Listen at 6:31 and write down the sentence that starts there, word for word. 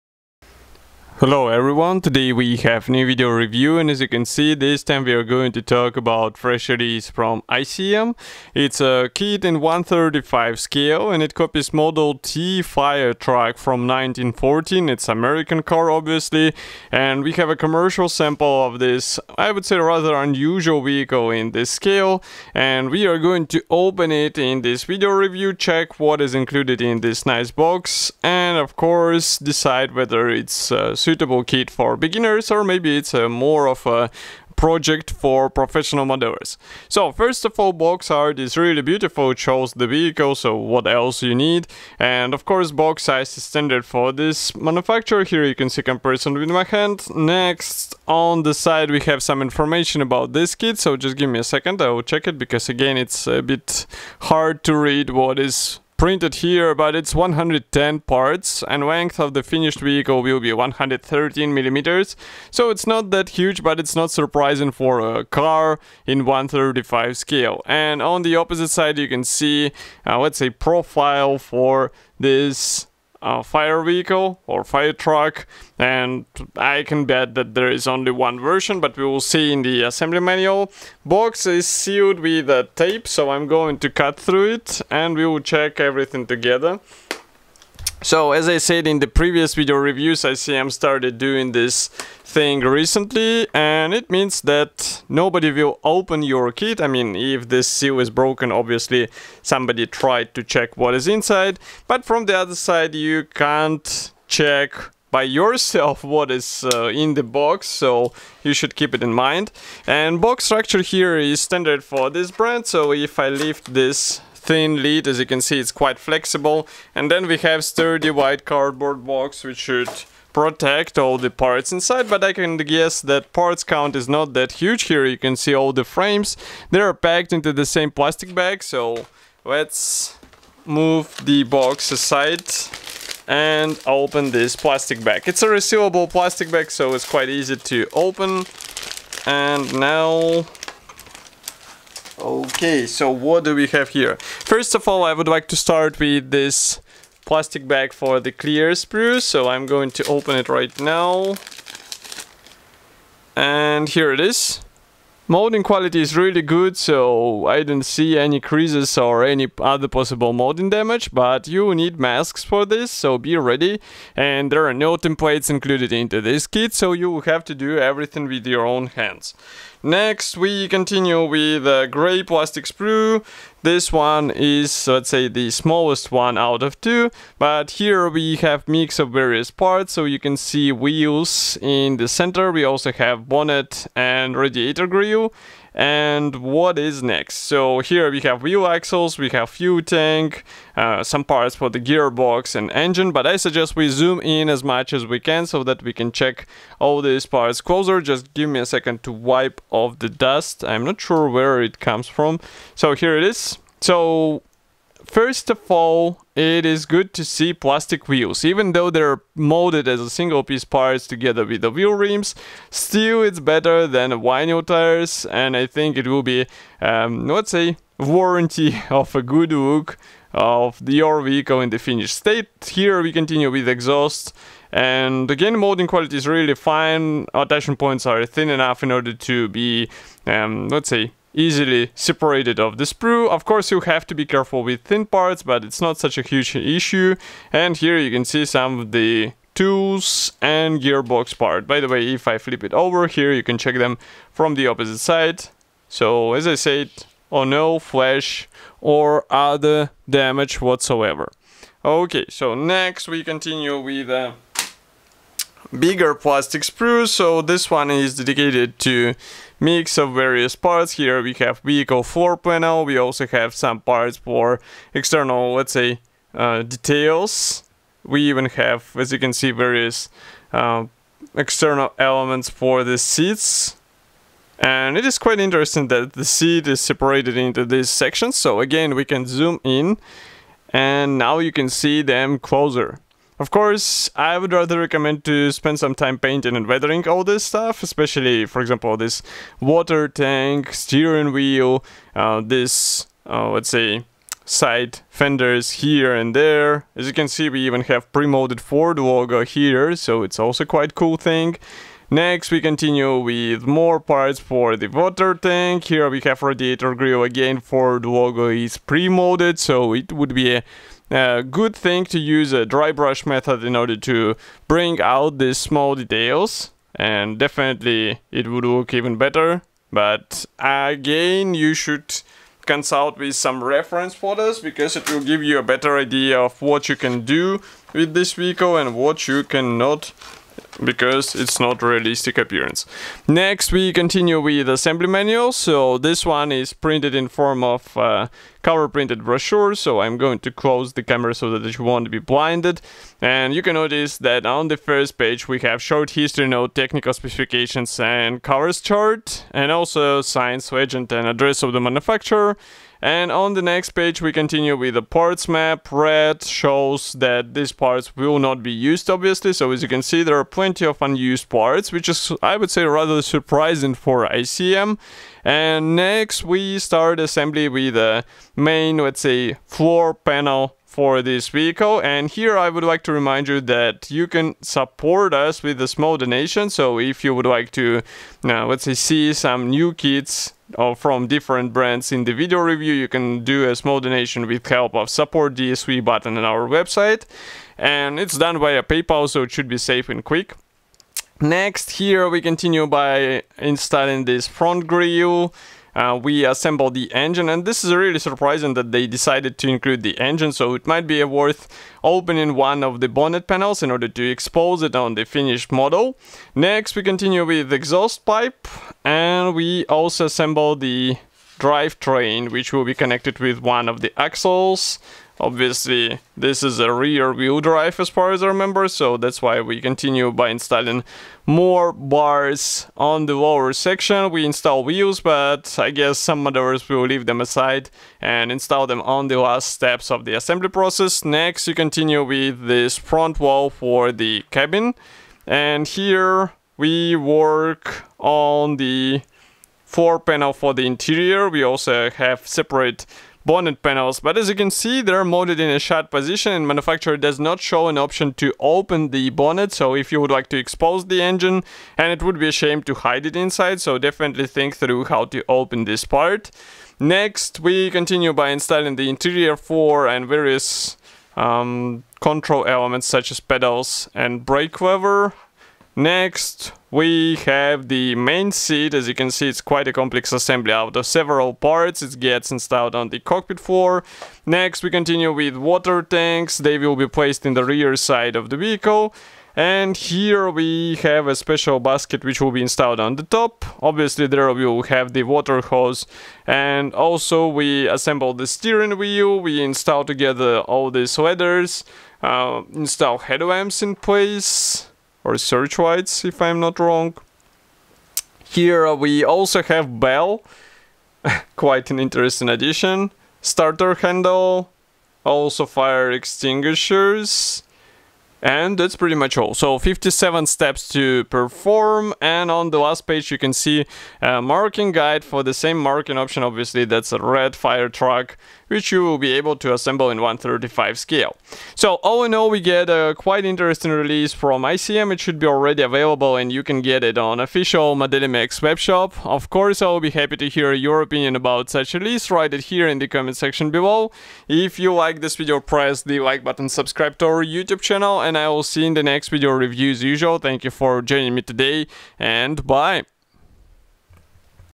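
Next, here we continue by installing this front grille.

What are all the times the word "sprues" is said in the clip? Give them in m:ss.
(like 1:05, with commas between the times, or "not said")
2:28, 2:52, 3:52, 4:16.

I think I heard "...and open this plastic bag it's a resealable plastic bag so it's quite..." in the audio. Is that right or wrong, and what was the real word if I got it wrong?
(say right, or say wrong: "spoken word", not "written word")
right.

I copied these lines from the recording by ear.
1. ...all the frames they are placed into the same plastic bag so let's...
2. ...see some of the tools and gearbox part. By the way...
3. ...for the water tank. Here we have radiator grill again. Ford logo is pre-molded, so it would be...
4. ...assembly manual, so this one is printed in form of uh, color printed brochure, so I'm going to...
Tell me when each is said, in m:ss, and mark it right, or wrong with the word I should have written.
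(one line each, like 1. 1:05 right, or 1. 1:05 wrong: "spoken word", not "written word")
1. 2:05 wrong: "packed", not "placed"
2. 3:58 right
3. 5:04 right
4. 5:34 right.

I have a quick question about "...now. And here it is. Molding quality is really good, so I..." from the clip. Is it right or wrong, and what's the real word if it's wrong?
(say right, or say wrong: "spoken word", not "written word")
right.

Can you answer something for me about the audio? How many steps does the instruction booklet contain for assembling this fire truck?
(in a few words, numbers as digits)
57.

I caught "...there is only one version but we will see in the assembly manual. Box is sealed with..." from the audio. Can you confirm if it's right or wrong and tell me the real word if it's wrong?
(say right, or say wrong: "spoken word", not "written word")
right.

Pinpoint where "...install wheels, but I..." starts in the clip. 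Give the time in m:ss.
7:04.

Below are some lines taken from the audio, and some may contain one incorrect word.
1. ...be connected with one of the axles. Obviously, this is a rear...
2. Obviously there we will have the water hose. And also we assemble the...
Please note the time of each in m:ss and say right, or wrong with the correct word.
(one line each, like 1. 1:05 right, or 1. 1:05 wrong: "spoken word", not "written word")
1. 6:52 right
2. 8:03 right.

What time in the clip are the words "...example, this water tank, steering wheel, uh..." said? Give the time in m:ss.
4:48.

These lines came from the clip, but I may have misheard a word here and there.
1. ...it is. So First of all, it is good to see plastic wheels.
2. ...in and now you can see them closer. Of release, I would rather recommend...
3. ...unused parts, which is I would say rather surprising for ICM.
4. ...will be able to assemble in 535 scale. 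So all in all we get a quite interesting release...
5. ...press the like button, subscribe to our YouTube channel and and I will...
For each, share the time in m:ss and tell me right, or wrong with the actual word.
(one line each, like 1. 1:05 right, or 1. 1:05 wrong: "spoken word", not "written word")
1. 3:23 right
2. 4:39 wrong: "course", not "release"
3. 6:01 right
4. 8:39 wrong: "135", not "535"
5. 8:55 right.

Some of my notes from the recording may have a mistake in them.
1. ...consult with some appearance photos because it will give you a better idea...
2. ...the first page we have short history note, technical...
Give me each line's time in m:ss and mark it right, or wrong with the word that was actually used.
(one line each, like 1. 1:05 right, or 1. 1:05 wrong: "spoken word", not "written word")
1. 5:22 wrong: "reference", not "appearance"
2. 5:44 right.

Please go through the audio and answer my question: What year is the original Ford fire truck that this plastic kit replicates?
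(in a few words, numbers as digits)
1914.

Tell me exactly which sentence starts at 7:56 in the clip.
They will be placed in the rear side of the vehicle.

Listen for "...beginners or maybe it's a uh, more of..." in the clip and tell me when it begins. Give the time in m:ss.
0:31.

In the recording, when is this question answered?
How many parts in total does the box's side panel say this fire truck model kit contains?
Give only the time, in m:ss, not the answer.
0:57.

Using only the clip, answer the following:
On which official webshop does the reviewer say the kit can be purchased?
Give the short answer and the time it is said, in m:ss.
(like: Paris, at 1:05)
Modelimex, at 8:47.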